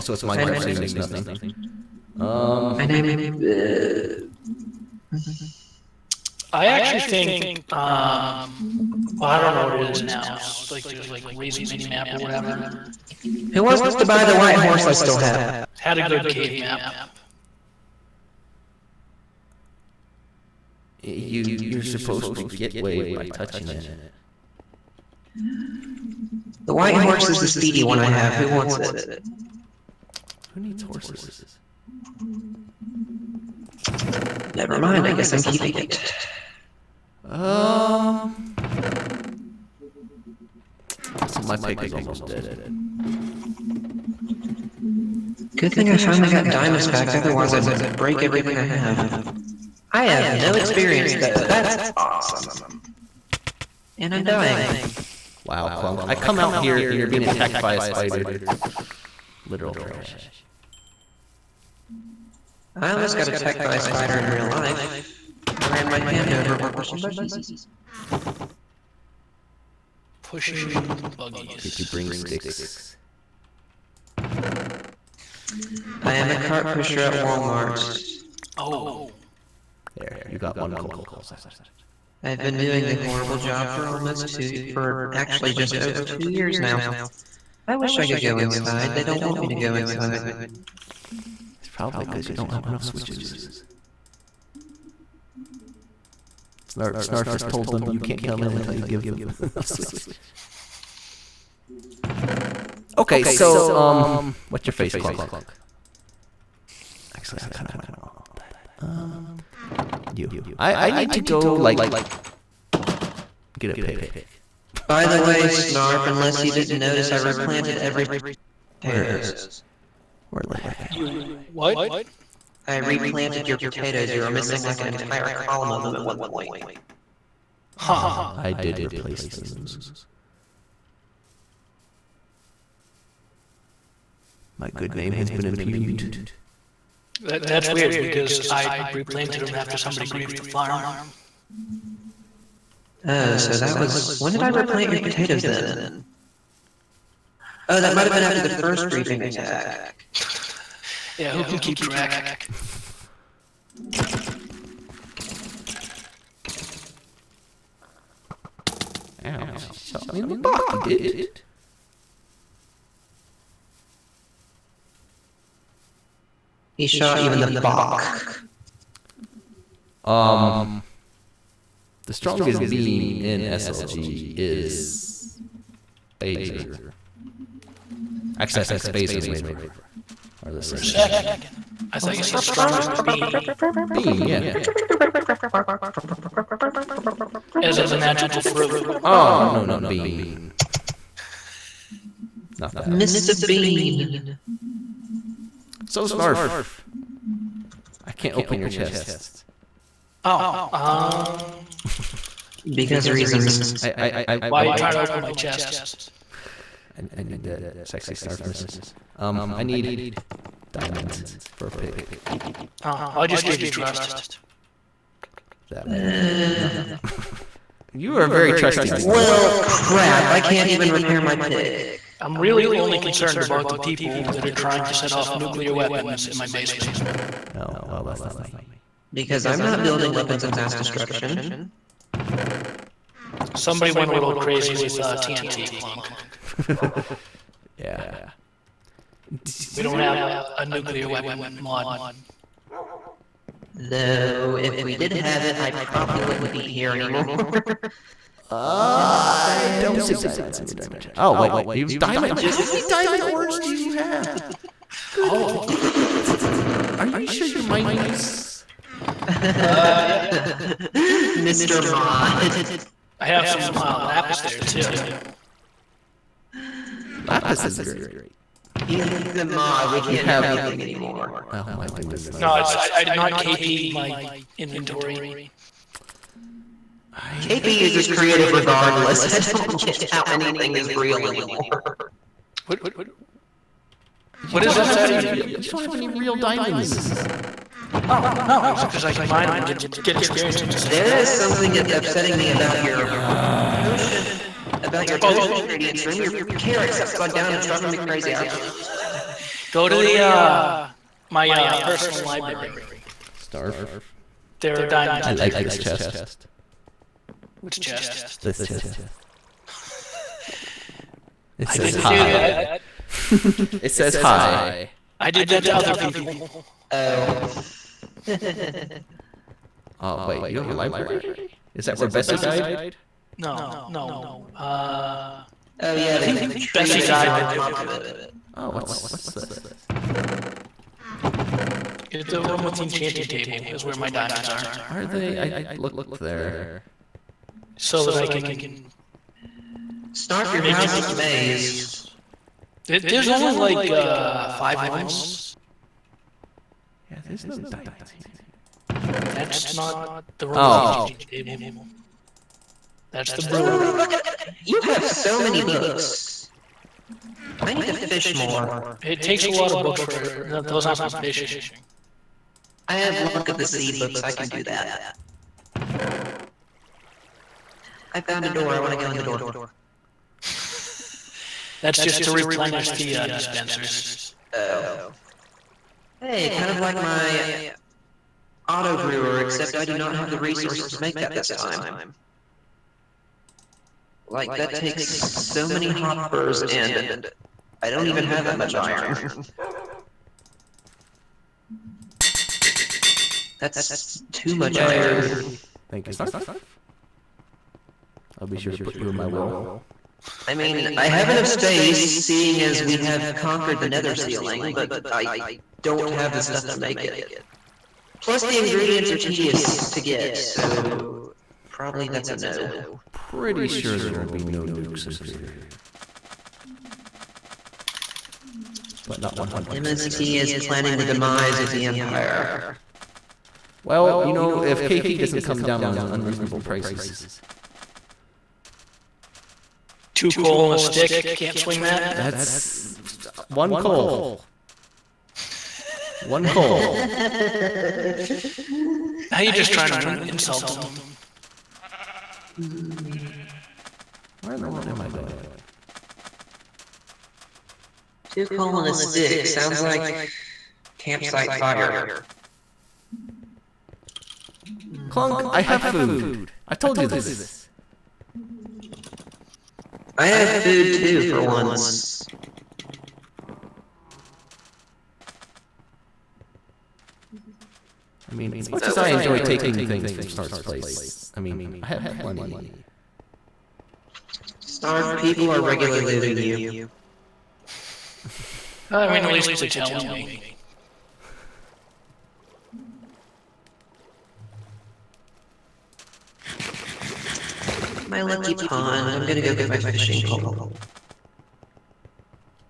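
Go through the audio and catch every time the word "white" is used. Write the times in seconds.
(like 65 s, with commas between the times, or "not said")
14 s, 26 s.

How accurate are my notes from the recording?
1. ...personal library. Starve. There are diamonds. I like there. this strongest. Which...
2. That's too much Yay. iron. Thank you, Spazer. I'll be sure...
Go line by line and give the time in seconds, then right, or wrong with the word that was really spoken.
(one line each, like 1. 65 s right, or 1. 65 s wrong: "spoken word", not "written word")
1. 301 s wrong: "chest", not "strongest"
2. 393 s wrong: "Snarf", not "Spazer".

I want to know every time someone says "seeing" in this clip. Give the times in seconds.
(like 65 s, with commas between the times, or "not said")
401 s.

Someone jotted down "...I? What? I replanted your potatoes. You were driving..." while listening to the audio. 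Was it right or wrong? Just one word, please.
wrong.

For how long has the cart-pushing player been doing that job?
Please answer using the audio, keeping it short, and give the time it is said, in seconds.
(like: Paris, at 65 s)
Just over 2 years, at 84 s.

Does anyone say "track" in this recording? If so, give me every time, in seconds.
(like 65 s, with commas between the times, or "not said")
151 s.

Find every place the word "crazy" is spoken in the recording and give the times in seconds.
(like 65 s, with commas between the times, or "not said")
234 s, 297 s.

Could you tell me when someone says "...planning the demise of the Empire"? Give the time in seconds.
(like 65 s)
420 s.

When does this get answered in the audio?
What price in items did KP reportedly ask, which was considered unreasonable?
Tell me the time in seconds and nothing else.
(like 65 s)
430 s.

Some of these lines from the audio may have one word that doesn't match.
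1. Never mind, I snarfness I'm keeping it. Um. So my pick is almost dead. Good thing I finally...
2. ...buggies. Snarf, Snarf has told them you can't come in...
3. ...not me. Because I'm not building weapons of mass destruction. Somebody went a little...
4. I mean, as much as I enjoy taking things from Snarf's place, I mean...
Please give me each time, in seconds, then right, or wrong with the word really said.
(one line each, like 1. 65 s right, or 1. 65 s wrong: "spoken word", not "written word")
1. 34 s wrong: "guess", not "snarfness"
2. 92 s wrong: "switches", not "buggies"
3. 228 s right
4. 468 s right.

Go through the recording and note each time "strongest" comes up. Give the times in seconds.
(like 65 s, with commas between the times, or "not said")
172 s, 182 s.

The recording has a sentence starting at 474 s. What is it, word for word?
Snarf, people are regularly looting you.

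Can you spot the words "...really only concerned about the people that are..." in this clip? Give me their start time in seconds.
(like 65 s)
222 s.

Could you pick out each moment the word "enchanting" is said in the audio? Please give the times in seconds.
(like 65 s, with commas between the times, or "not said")
332 s, 350 s.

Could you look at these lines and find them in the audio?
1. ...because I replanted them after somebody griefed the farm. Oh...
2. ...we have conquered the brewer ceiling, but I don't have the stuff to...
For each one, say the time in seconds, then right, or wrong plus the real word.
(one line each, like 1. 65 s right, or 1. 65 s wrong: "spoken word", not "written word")
1. 137 s right
2. 402 s wrong: "nether", not "brewer".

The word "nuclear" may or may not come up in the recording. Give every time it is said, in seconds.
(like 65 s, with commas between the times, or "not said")
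225 s, 240 s.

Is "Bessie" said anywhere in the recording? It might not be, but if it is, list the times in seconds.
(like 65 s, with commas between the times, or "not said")
322 s, 326 s.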